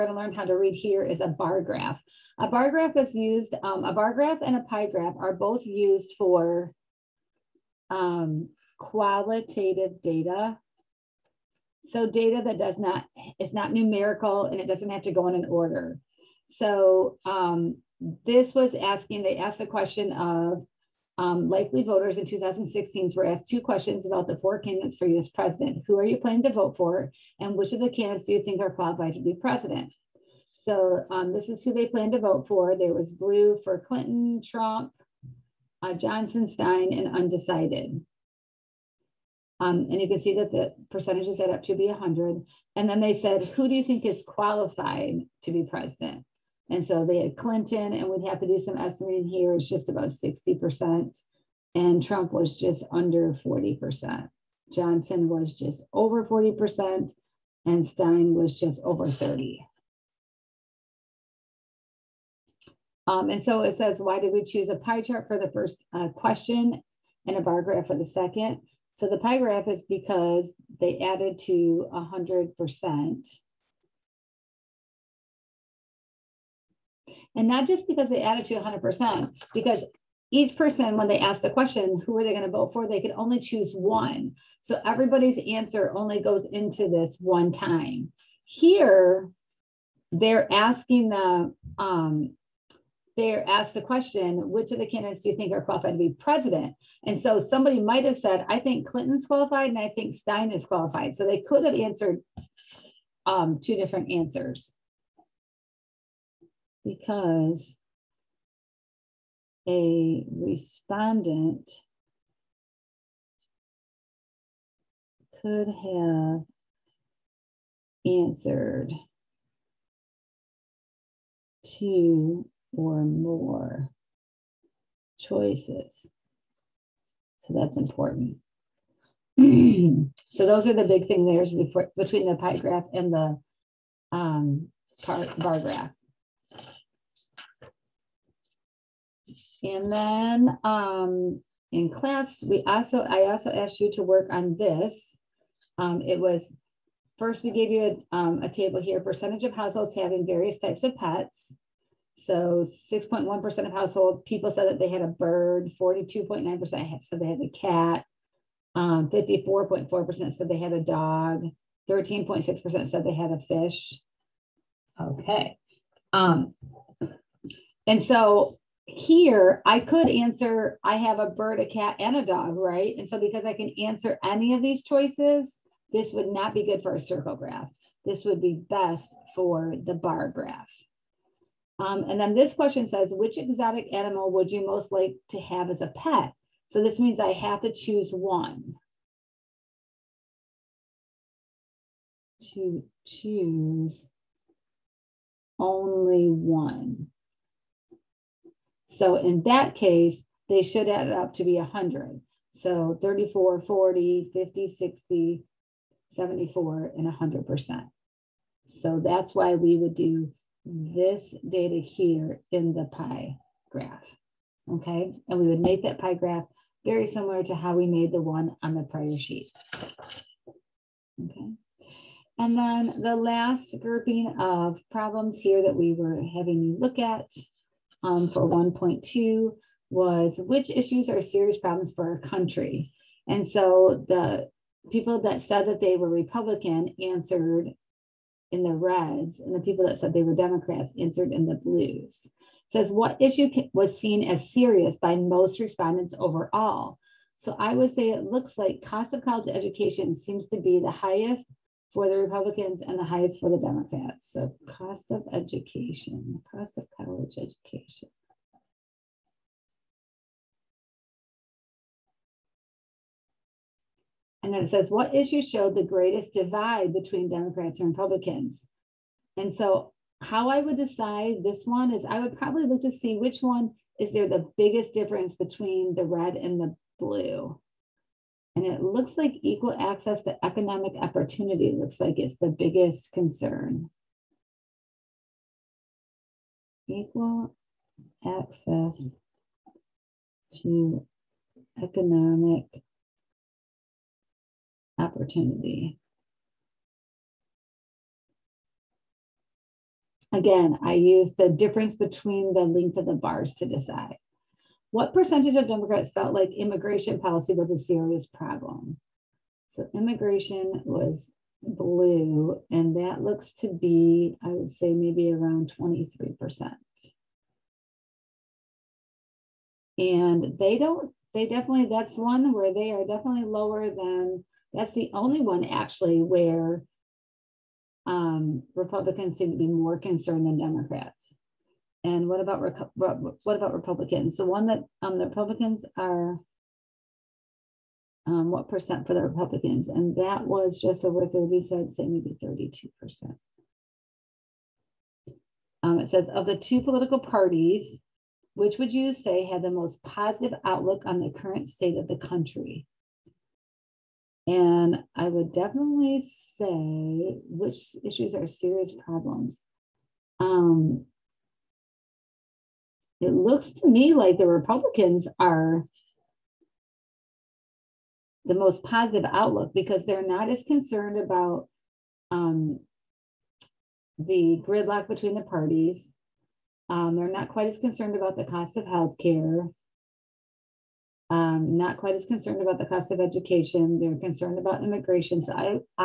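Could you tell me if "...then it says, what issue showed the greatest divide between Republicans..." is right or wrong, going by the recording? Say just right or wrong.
wrong.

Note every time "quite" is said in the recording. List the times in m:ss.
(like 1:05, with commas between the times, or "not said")
6:17, 6:21.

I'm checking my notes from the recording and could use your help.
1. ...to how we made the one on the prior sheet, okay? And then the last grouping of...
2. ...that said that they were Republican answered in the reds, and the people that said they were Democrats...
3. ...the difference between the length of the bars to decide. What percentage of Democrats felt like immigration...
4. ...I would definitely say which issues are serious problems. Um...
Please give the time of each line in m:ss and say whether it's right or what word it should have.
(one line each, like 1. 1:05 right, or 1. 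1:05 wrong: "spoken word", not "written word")
1. 3:37 right
2. 3:55 right
3. 5:01 right
4. 5:55 right.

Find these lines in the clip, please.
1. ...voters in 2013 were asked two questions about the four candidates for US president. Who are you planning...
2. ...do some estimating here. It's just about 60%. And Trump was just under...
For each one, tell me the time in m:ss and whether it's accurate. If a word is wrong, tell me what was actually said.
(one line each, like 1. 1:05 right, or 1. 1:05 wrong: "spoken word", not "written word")
1. 0:21 wrong: "2016", not "2013"
2. 0:48 right.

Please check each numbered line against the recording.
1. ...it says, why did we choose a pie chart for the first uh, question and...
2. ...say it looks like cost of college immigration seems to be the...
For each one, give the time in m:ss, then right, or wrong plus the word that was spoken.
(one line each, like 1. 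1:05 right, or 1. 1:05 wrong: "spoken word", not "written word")
1. 1:03 right
2. 4:07 wrong: "education", not "immigration".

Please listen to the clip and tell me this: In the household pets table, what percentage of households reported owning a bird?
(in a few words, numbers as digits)
6.1%.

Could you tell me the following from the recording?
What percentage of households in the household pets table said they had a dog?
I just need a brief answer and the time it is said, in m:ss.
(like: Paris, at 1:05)
54.4%, at 2:38.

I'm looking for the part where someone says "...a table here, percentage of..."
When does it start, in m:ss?
2:28.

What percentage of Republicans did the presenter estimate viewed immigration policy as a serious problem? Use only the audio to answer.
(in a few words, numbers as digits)
32%.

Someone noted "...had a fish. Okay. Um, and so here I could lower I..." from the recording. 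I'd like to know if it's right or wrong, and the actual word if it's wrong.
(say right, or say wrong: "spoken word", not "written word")
wrong: "answer", not "lower".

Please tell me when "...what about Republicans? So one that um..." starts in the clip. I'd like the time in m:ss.
5:32.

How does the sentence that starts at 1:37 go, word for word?
And so somebody might have said, I think Clinton's qualified and I think Stein is qualified.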